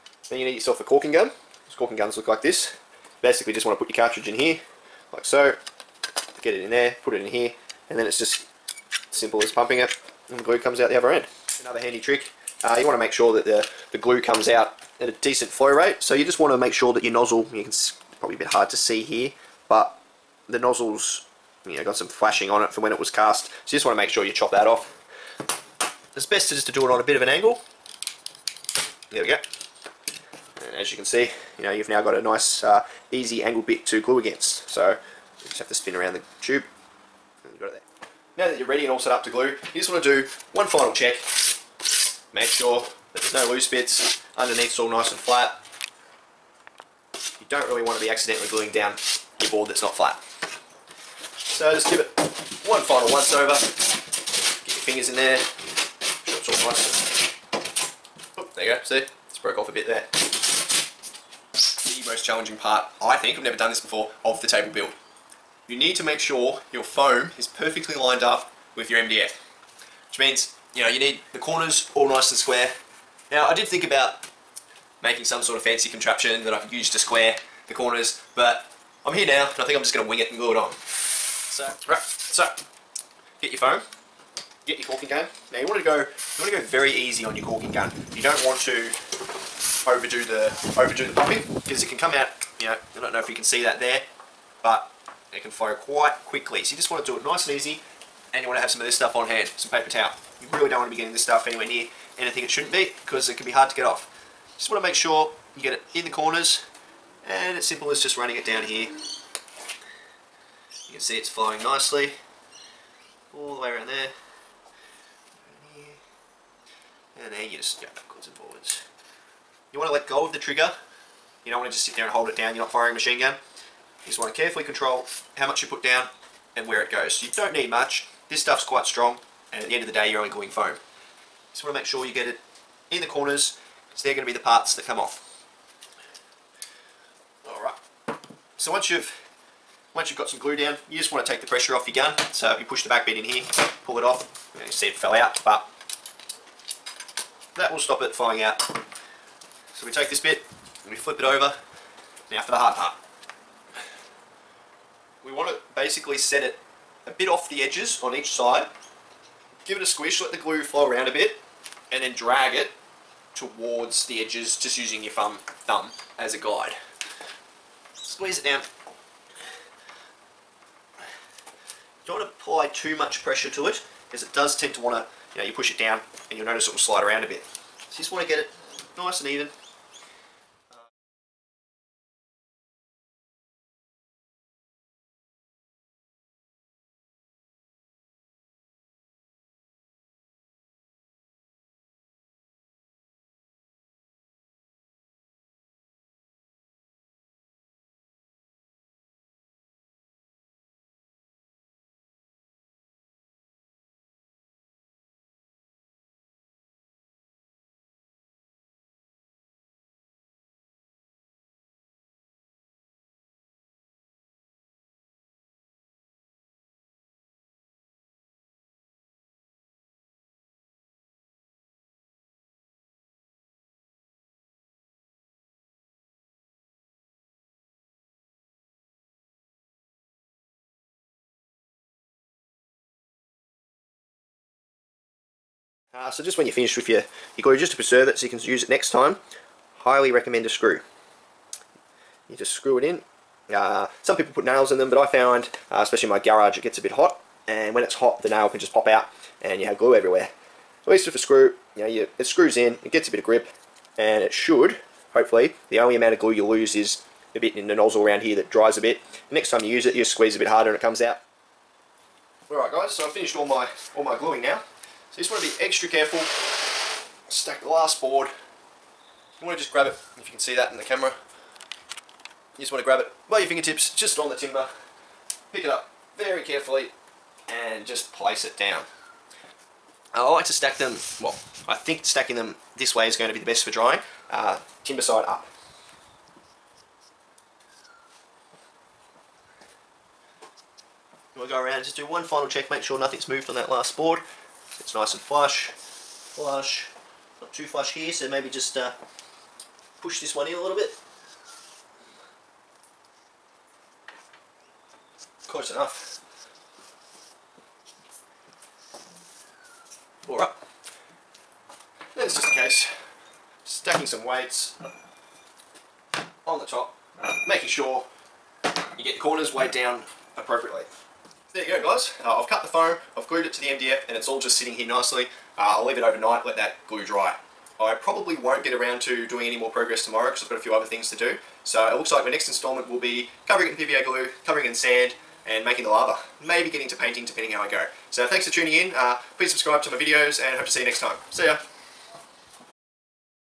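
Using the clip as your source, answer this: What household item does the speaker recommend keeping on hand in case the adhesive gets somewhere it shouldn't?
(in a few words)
paper towel.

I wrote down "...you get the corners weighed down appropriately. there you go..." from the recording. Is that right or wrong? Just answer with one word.
right.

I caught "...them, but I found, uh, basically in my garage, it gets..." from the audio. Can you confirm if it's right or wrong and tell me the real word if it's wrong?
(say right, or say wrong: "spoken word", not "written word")
wrong: "especially", not "basically".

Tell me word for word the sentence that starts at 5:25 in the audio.
Uh, I'll leave it overnight, let that glue dry.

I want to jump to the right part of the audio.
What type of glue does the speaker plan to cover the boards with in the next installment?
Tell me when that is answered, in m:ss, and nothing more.
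5:33.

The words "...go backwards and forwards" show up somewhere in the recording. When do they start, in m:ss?
1:57.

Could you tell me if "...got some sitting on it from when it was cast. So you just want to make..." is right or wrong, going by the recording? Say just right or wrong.
wrong.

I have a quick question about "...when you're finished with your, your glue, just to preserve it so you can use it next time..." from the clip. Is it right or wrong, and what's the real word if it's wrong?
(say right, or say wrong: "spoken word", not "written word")
right.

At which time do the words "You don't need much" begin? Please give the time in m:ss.
2:07.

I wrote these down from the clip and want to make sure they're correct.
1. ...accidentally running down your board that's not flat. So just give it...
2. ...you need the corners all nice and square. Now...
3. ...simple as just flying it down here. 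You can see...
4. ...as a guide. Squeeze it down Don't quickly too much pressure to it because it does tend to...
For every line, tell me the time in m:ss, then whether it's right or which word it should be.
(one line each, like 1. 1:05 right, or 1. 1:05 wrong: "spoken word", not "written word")
1. 0:48 wrong: "gluing", not "running"
2. 1:10 right
3. 1:47 wrong: "running", not "flying"
4. 2:46 wrong: "apply", not "quickly".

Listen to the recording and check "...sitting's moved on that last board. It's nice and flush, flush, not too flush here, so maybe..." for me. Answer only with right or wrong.
wrong.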